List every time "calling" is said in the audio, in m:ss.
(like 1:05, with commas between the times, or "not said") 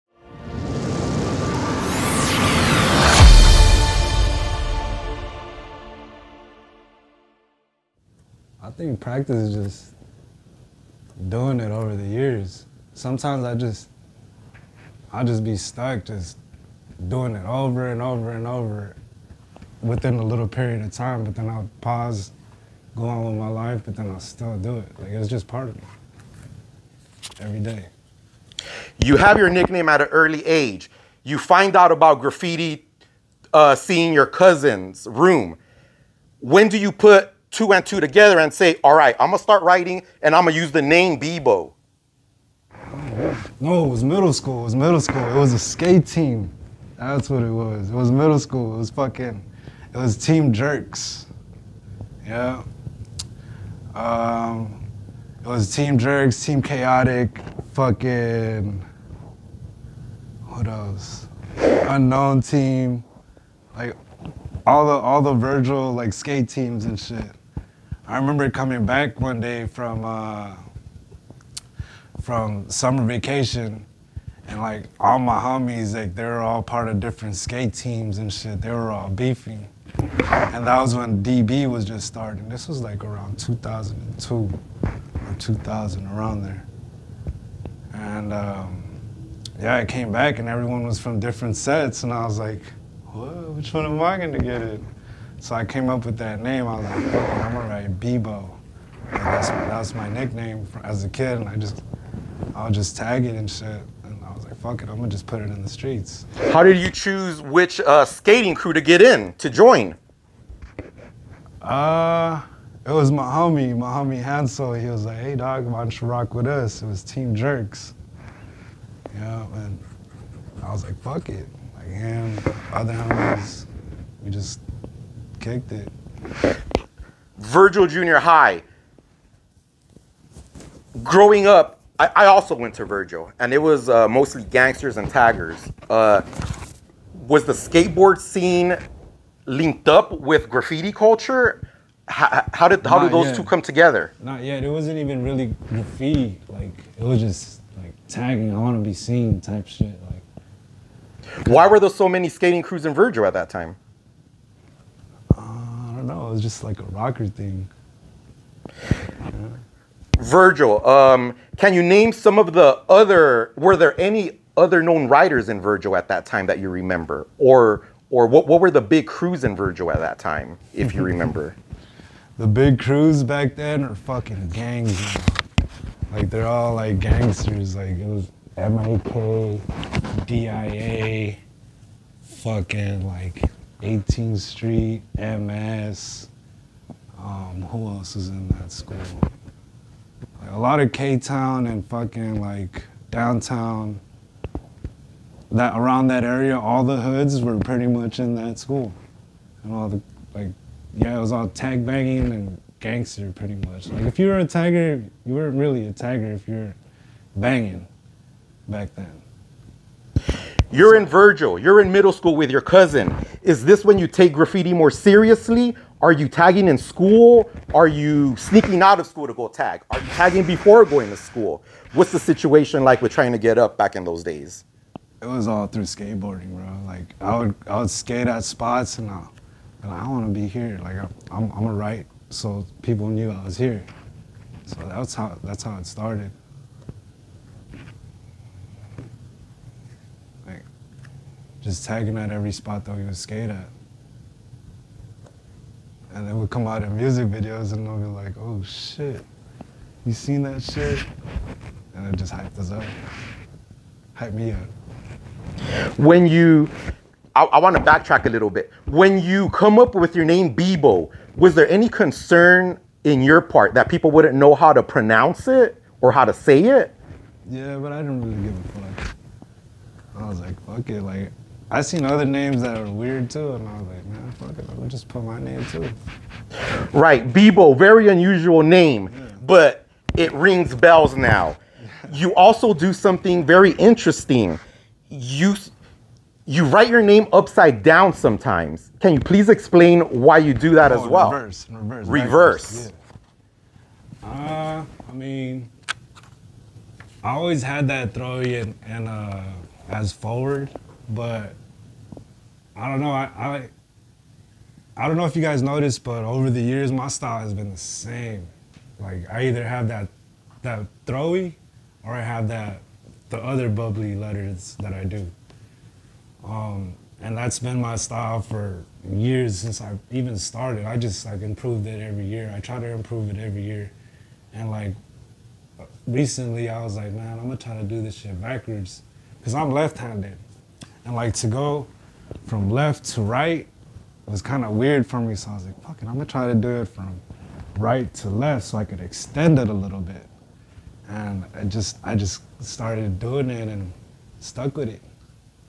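not said.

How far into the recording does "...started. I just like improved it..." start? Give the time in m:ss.
5:20.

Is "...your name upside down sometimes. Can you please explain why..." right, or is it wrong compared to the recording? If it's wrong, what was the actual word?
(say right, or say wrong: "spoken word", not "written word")
right.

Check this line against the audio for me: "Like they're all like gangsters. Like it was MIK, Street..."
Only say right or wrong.
wrong.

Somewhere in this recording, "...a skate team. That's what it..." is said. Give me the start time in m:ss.
0:45.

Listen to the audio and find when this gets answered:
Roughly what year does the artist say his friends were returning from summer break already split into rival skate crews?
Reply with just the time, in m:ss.
1:23.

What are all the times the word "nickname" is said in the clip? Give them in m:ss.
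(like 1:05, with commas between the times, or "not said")
0:29, 1:40.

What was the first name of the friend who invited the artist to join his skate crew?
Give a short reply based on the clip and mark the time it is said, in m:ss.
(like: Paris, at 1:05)
Hansel, at 1:54.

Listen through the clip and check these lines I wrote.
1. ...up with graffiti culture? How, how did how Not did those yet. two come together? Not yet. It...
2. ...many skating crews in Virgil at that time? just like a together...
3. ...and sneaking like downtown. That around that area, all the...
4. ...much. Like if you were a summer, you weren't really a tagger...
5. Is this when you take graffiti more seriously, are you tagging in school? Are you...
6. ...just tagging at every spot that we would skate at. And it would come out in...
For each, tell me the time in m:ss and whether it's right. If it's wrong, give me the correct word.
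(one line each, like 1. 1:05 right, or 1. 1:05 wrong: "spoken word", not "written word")
1. 2:19 right
2. 2:32 wrong: "rocker", not "together"
3. 3:11 wrong: "fucking", not "sneaking"
4. 3:23 wrong: "tagger", not "summer"
5. 3:33 right
6. 4:01 right.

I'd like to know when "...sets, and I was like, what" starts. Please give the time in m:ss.
1:31.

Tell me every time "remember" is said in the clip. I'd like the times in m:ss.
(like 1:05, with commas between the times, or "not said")
1:08, 2:46, 2:51.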